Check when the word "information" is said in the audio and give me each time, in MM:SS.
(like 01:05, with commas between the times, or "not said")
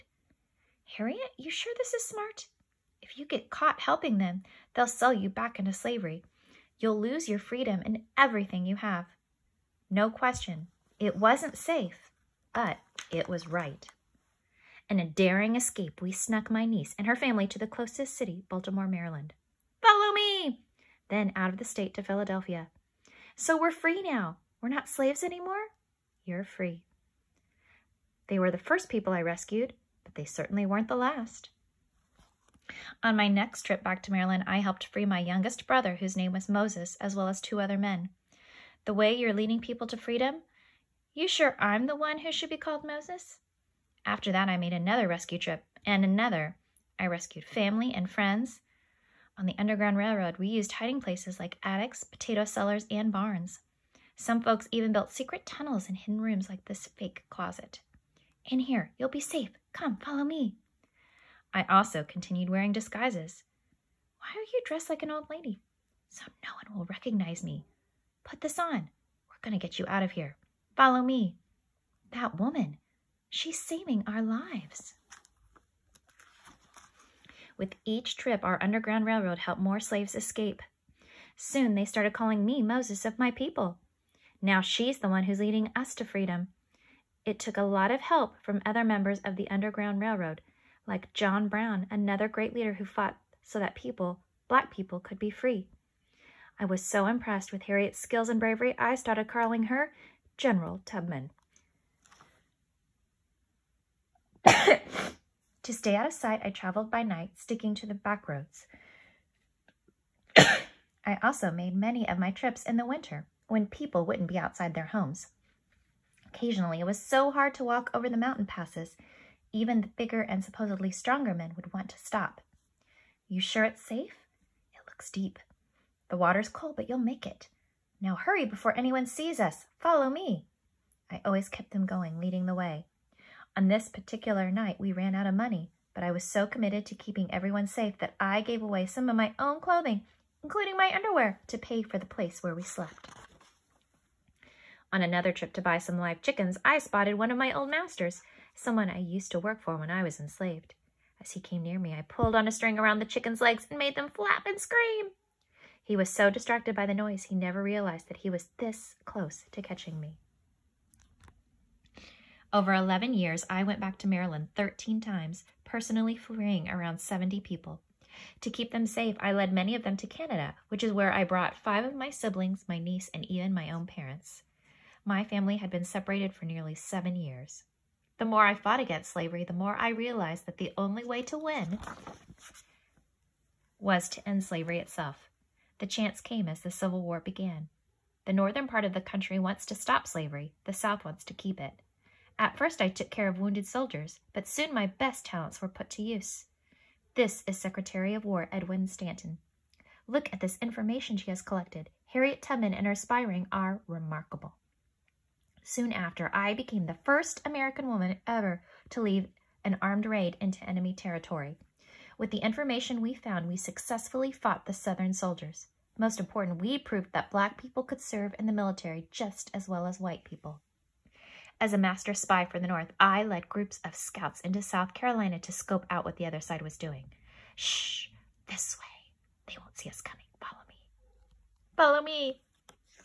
03:20, 03:32.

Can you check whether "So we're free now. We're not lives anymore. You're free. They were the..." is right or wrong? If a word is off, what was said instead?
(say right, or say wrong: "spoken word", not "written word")
wrong: "slaves", not "lives".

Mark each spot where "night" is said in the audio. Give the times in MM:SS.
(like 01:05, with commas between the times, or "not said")
01:47, 02:14.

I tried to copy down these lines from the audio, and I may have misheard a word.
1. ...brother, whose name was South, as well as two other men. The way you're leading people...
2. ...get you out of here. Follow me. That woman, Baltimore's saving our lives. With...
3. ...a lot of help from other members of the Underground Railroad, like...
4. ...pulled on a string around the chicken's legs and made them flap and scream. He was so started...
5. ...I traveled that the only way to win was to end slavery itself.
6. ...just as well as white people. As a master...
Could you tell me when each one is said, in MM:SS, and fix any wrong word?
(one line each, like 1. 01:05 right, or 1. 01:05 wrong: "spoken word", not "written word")
1. 00:35 wrong: "Moses", not "South"
2. 01:09 wrong: "She", not "Baltimore"
3. 01:27 right
4. 02:32 wrong: "distracted", not "started"
5. 02:59 wrong: "realized", not "traveled"
6. 03:39 right.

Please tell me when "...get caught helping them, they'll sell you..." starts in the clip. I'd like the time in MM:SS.
00:03.